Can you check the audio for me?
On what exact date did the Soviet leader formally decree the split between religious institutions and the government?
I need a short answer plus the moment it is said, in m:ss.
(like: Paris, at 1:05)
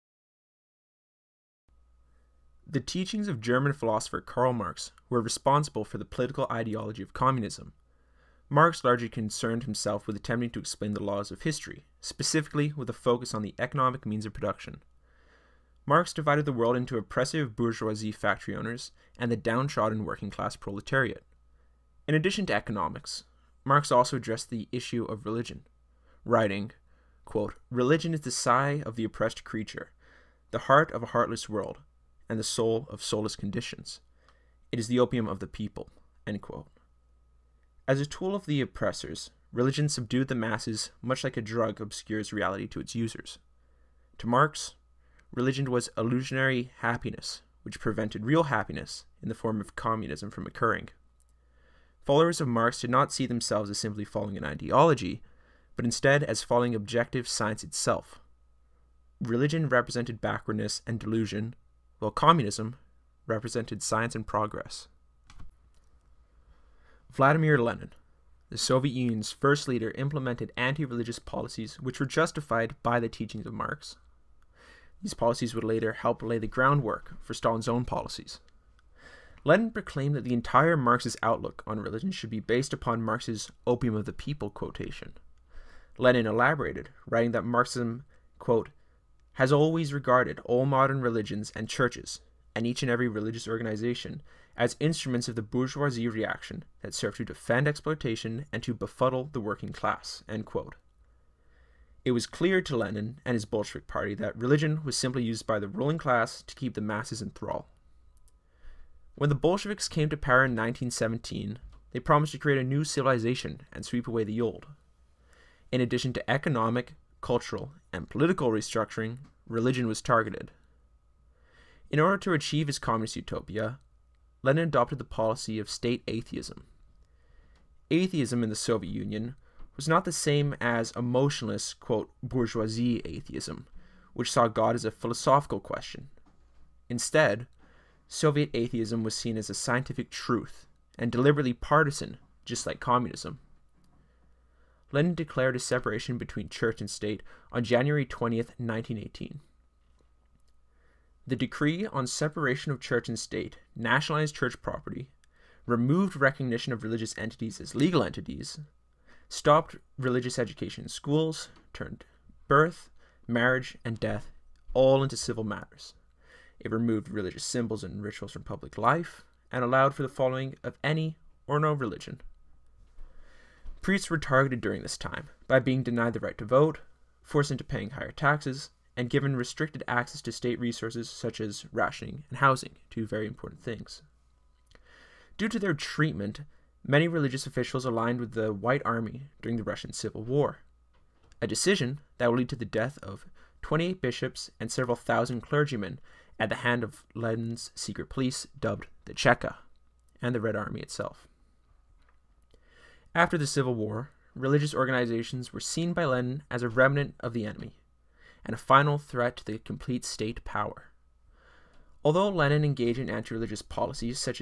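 January 20th, 1918, at 2:27.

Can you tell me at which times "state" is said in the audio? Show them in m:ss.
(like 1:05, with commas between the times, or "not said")
2:05, 2:26, 2:33, 3:00, 3:30.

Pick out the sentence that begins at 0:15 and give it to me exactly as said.
Marx divided the world into oppressive bourgeoisie factory owners and the downtrodden working class proletariat.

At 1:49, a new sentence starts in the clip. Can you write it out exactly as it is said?
When the Bolsheviks came to power in 1917, they promised to create a new civilization and sweep away the old.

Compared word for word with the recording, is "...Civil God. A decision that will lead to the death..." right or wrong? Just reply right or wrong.
wrong.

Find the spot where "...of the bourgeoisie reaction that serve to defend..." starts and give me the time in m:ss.
1:35.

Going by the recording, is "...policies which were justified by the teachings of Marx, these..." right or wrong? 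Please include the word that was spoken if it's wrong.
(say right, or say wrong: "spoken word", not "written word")
right.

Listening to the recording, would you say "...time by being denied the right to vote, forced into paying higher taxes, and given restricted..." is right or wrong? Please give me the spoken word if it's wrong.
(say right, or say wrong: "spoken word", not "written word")
right.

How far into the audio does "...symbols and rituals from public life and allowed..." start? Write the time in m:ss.
2:47.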